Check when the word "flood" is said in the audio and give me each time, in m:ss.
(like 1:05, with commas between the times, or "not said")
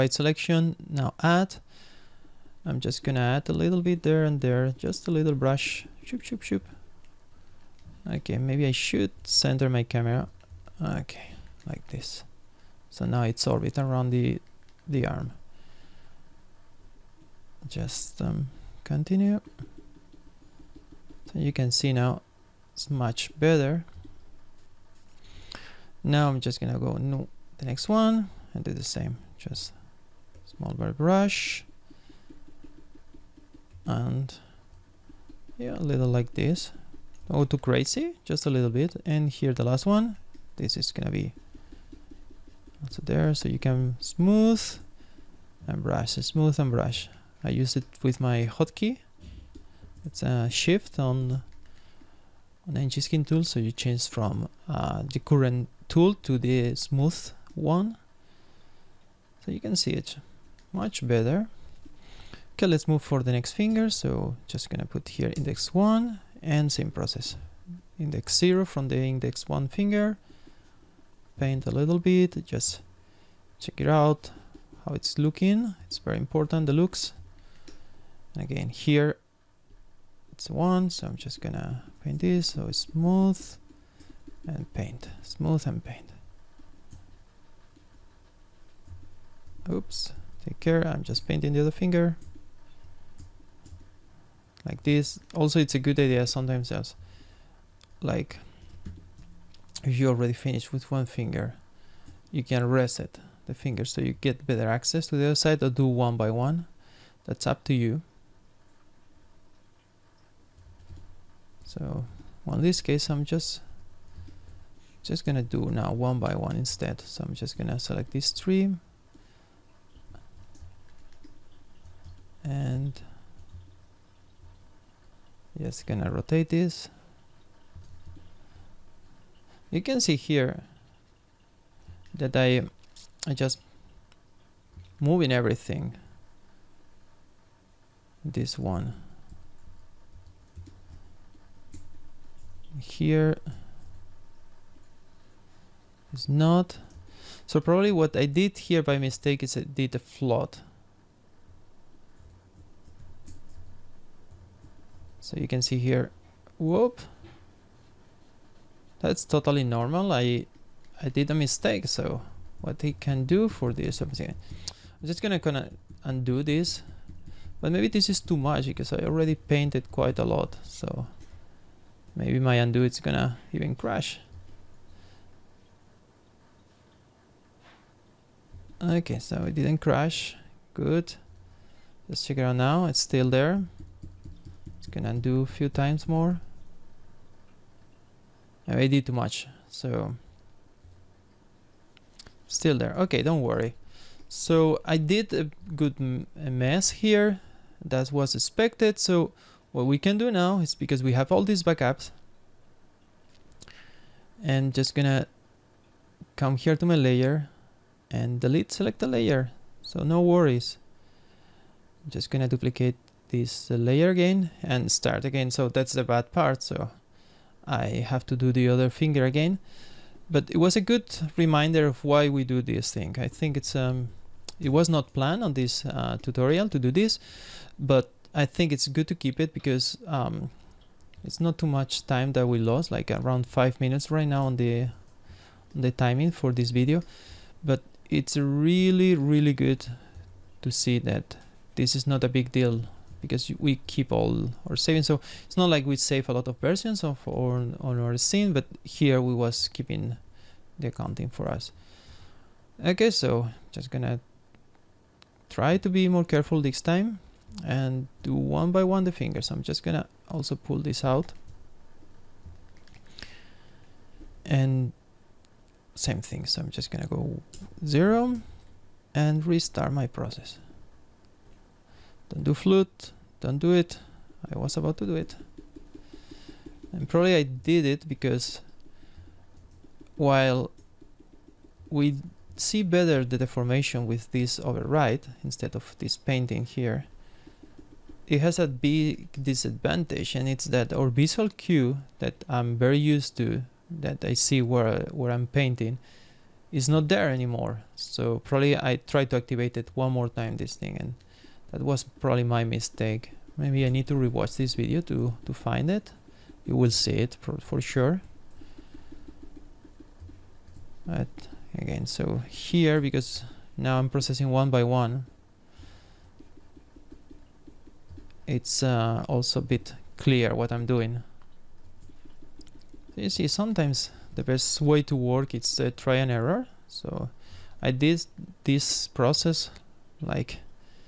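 2:29, 4:32.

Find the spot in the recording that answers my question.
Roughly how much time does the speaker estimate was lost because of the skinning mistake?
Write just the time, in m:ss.
3:53.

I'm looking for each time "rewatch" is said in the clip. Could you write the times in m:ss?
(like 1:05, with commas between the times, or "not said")
5:04.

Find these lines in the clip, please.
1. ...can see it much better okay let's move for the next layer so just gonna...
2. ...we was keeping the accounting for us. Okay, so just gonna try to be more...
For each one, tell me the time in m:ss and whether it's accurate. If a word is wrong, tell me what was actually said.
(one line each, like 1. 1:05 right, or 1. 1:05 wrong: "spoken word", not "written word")
1. 0:59 wrong: "finger", not "layer"
2. 4:09 right.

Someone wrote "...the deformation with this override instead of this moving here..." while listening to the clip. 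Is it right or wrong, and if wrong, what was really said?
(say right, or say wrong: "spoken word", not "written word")
wrong: "painting", not "moving".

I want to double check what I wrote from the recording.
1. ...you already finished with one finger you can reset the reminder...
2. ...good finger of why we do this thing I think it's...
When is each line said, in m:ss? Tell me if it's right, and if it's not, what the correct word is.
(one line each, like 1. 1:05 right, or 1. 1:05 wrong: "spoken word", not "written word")
1. 1:39 wrong: "finger", not "reminder"
2. 3:40 wrong: "reminder", not "finger".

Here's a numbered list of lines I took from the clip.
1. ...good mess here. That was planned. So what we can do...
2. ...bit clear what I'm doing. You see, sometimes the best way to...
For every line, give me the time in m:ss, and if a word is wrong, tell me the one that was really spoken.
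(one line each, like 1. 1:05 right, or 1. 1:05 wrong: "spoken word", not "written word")
1. 3:15 wrong: "expected", not "planned"
2. 5:19 right.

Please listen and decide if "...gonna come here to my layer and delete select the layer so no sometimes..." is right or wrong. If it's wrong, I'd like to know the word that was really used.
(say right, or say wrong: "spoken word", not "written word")
wrong: "worries", not "sometimes".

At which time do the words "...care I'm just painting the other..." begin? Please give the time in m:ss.
1:30.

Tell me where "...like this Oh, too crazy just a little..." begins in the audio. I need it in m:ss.
0:36.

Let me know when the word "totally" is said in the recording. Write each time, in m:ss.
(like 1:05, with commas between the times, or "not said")
2:39.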